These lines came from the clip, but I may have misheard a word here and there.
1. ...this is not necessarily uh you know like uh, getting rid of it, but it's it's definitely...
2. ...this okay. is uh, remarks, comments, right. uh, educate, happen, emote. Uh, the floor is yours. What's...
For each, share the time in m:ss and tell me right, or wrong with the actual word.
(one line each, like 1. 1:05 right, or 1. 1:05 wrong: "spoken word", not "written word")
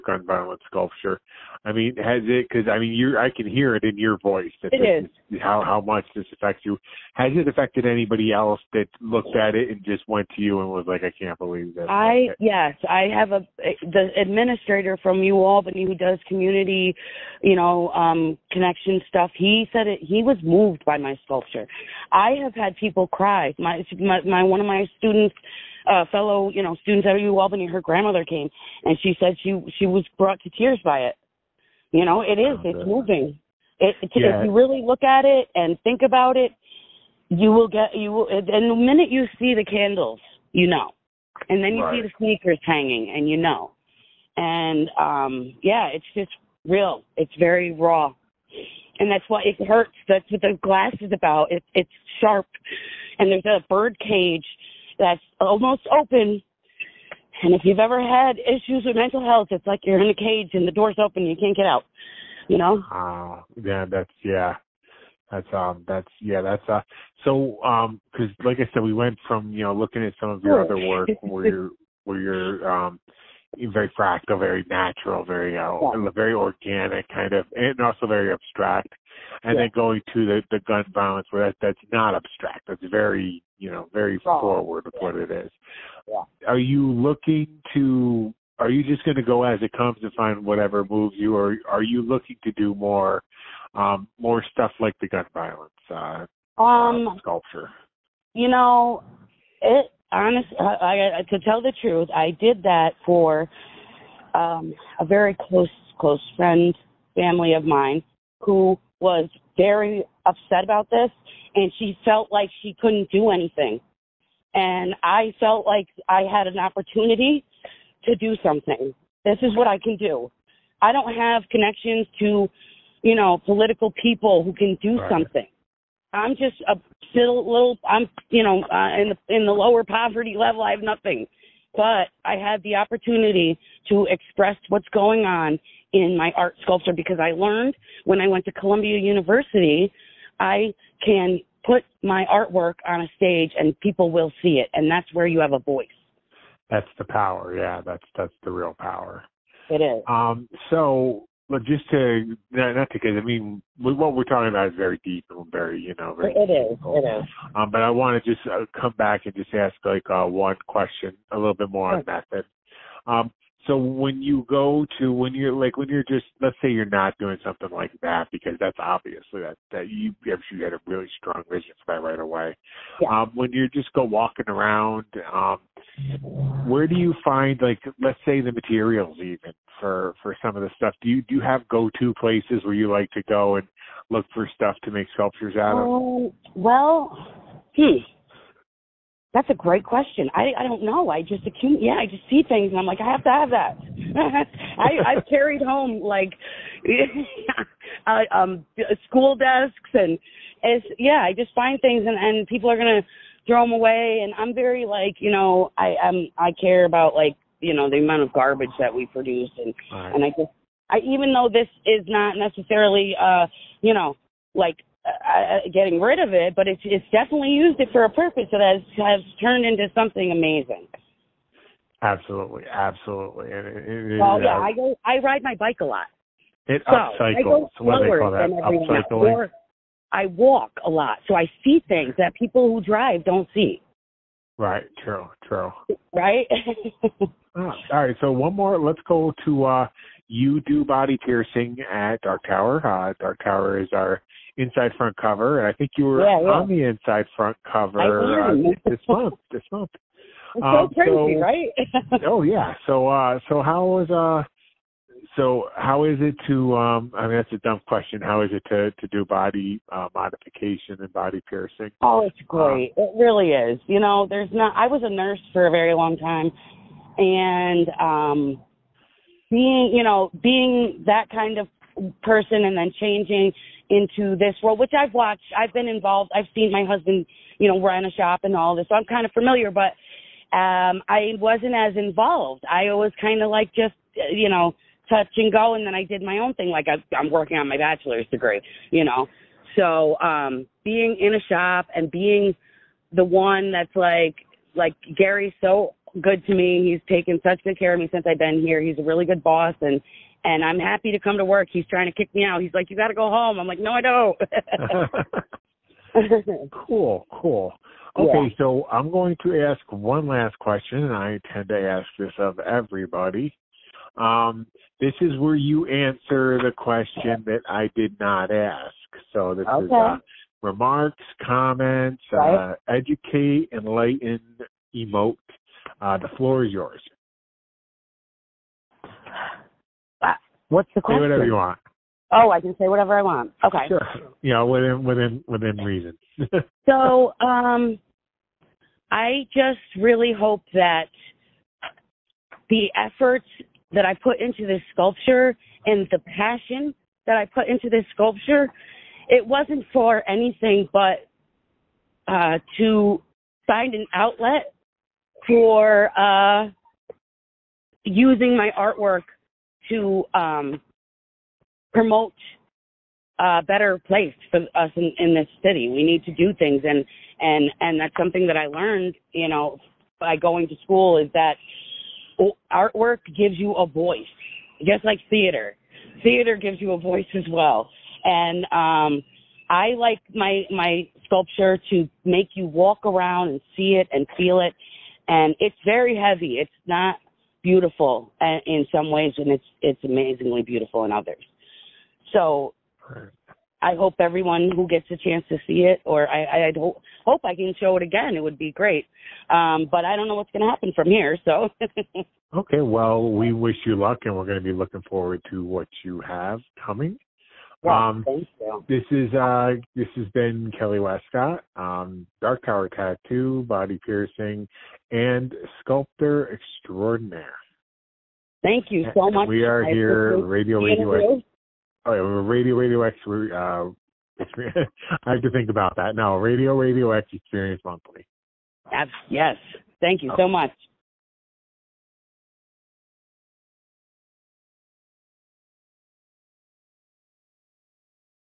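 1. 3:31 right
2. 5:19 wrong: "enlighten", not "happen".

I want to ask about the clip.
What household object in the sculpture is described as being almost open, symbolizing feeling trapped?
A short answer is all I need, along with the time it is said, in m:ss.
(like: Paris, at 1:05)
Bird cage, at 0:53.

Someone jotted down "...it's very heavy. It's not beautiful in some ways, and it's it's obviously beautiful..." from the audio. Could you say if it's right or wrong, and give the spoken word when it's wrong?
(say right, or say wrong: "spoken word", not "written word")
wrong: "amazingly", not "obviously".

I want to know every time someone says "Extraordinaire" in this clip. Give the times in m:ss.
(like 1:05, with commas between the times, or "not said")
6:56.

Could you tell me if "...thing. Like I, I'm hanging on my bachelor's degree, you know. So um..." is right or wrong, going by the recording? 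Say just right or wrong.
wrong.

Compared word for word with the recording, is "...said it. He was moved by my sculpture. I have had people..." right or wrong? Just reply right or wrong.
right.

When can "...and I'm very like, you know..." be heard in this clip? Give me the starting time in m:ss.
3:24.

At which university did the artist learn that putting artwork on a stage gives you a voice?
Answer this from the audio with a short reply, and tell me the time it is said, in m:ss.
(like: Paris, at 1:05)
Columbia University, at 2:18.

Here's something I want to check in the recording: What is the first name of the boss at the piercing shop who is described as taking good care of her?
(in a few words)
Gary.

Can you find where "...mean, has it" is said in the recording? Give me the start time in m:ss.
0:01.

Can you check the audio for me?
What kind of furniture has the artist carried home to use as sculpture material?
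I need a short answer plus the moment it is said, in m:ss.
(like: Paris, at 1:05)
School desks, at 3:19.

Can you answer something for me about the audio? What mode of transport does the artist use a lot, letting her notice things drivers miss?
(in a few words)
Bike.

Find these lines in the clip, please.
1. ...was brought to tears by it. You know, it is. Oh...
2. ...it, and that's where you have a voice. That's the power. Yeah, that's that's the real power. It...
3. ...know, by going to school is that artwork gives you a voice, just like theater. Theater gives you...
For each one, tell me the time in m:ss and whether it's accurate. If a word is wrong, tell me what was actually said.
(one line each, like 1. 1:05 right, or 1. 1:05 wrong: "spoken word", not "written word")
1. 0:29 right
2. 2:24 right
3. 6:09 right.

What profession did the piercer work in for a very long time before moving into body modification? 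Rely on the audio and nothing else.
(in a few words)
Nurse.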